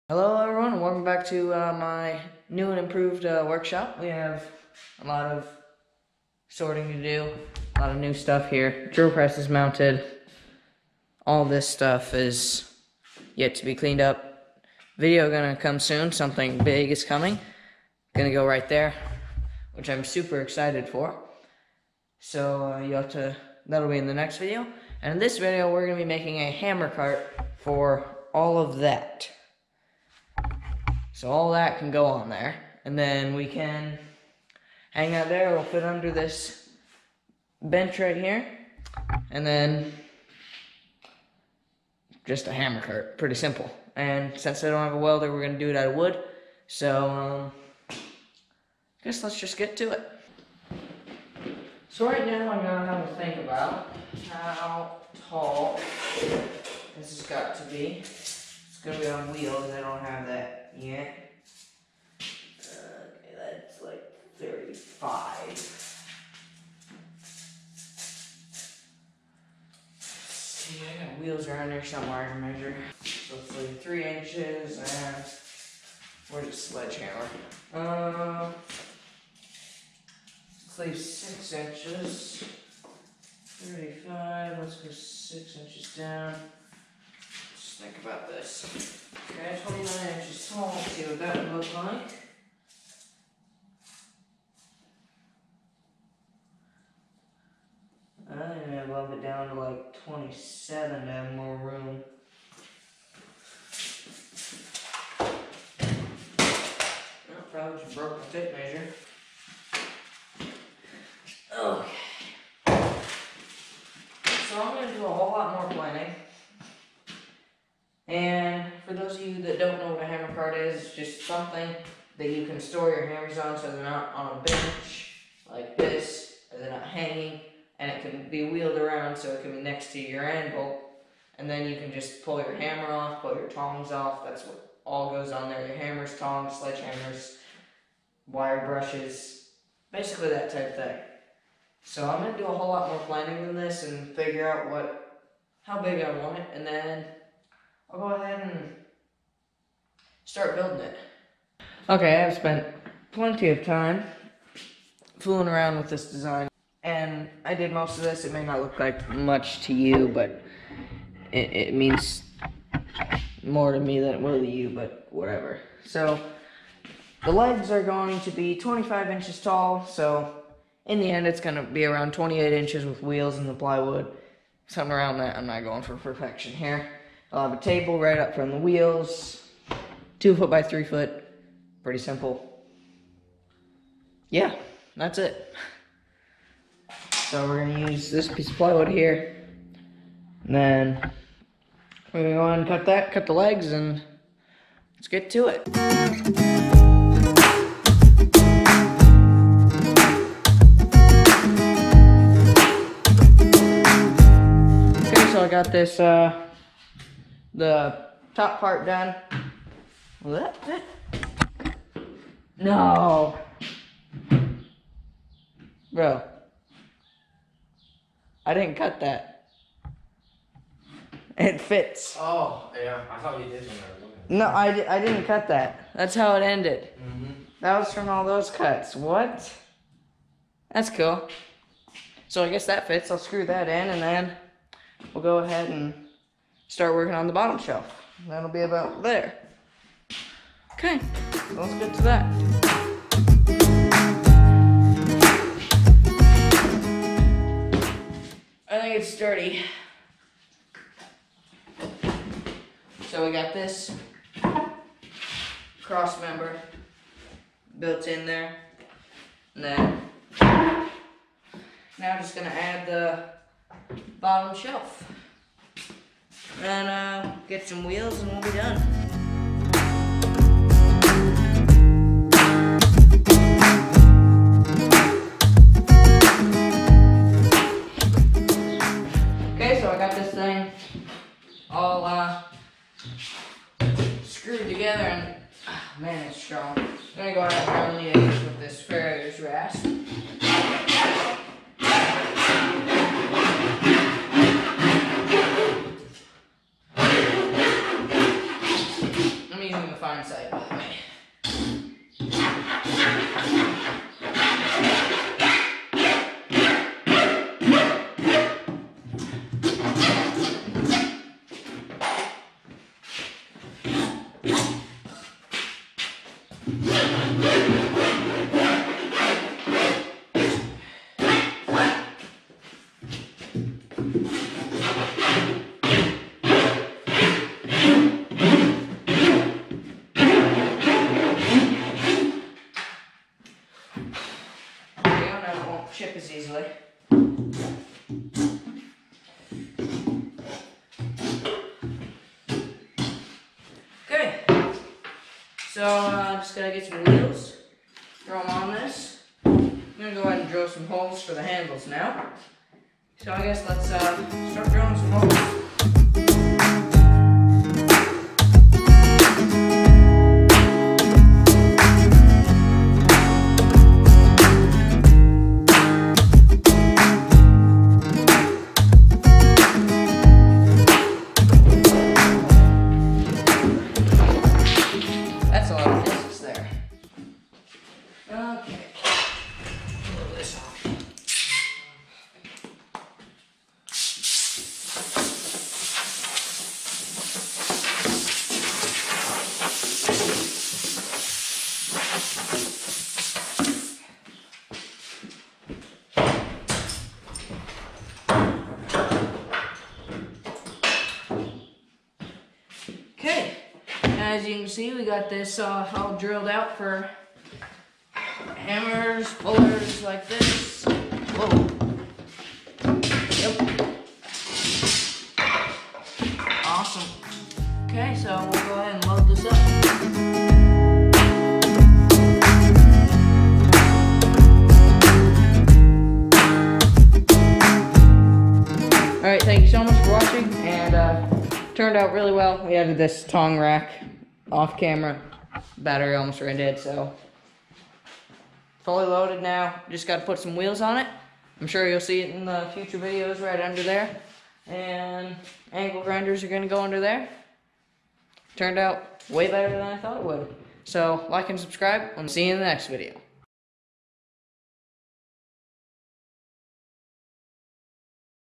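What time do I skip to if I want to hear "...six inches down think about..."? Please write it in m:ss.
1:24.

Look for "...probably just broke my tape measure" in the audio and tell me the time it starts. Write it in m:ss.
1:47.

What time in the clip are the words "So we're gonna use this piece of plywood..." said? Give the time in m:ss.
3:07.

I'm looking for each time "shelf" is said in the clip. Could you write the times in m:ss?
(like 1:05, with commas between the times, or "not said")
3:57, 4:24.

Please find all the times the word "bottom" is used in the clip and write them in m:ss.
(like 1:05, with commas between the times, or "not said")
3:57, 4:24.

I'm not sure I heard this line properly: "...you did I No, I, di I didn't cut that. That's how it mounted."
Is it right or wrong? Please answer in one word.
wrong.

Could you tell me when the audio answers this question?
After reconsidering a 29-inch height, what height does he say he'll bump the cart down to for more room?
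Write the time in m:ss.
1:39.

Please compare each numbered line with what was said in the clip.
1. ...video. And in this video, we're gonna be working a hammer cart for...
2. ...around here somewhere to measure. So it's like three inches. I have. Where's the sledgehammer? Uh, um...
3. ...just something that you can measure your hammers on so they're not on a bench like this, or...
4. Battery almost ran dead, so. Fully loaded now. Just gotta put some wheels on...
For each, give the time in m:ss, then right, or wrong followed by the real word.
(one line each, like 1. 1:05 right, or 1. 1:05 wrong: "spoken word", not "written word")
1. 0:24 wrong: "making", not "working"
2. 1:11 right
3. 2:00 wrong: "store", not "measure"
4. 7:15 right.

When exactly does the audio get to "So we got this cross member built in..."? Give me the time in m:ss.
4:13.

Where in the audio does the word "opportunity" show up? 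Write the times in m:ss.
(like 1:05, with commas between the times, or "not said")
not said.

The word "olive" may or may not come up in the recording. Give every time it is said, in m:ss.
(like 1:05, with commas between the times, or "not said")
not said.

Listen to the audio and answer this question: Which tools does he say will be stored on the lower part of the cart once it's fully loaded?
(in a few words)
angle grinders.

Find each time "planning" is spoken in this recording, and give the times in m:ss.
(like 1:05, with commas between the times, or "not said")
1:55, 2:23.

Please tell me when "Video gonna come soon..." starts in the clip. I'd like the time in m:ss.
0:14.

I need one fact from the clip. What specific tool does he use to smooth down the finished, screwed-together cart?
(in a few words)
farrier's rasp.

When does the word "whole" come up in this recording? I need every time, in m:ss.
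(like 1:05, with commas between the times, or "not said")
1:55, 2:22.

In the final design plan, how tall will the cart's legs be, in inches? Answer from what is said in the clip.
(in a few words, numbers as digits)
25 inches.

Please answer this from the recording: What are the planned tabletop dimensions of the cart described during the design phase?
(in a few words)
two foot by three foot.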